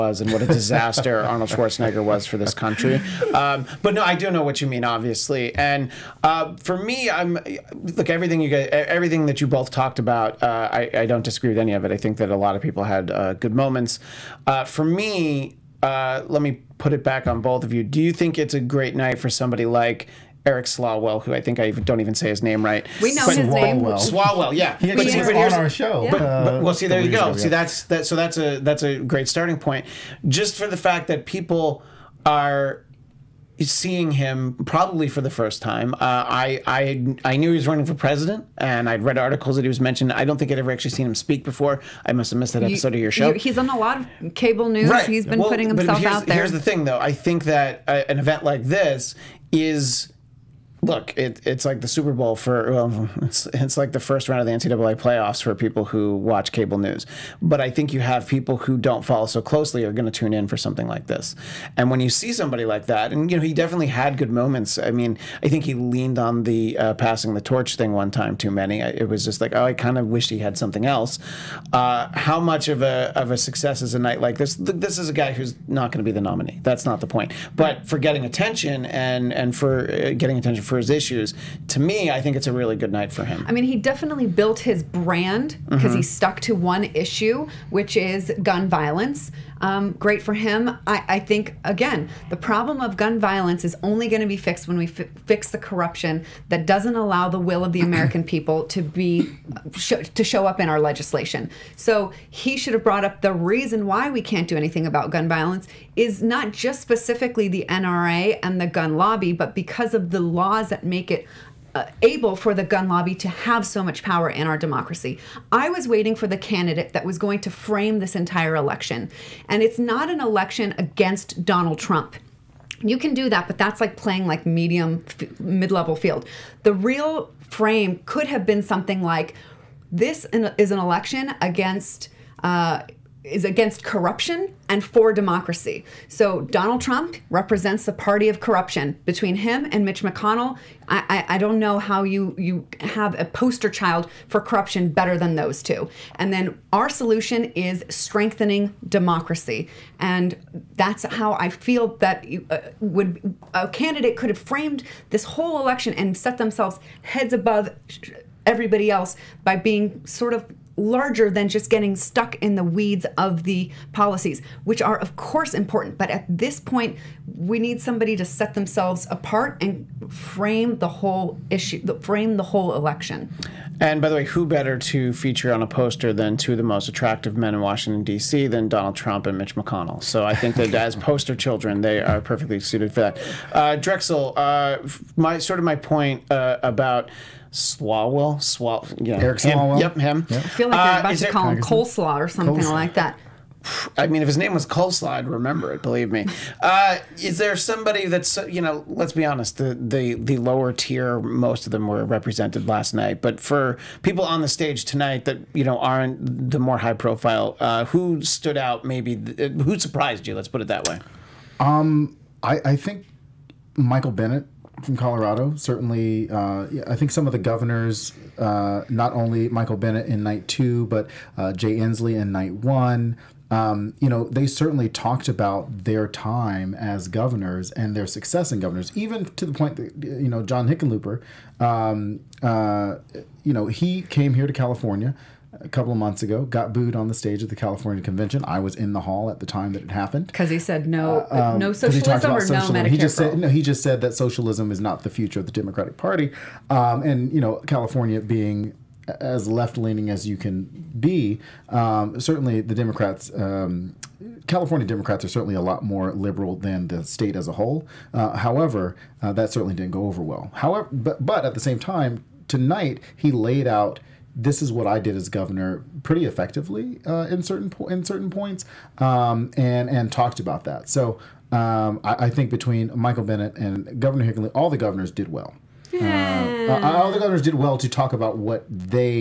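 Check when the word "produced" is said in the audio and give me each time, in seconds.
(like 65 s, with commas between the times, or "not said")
not said.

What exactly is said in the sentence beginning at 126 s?
The real frame could have been something like this is an election against.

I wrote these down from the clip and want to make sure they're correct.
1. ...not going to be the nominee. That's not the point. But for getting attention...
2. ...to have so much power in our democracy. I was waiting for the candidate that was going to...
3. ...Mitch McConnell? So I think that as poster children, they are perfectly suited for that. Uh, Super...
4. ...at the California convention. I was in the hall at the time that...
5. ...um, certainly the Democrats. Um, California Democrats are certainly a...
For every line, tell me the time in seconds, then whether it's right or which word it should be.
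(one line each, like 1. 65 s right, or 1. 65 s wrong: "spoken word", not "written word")
1. 75 s right
2. 113 s right
3. 179 s wrong: "Drexel", not "Super"
4. 237 s right
5. 251 s right.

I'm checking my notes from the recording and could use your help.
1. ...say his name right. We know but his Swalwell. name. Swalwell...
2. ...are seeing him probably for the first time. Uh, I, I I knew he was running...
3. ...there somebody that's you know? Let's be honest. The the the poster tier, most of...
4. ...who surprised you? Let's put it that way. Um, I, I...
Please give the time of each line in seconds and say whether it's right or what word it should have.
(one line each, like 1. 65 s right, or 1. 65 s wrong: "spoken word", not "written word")
1. 22 s right
2. 32 s right
3. 197 s wrong: "lower", not "poster"
4. 209 s right.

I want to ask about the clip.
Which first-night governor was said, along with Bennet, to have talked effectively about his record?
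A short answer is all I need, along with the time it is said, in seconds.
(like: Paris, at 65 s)
Jay Inslee, at 221 s.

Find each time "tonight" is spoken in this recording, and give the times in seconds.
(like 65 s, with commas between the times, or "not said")
204 s, 262 s.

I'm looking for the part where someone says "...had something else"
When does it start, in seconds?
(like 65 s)
70 s.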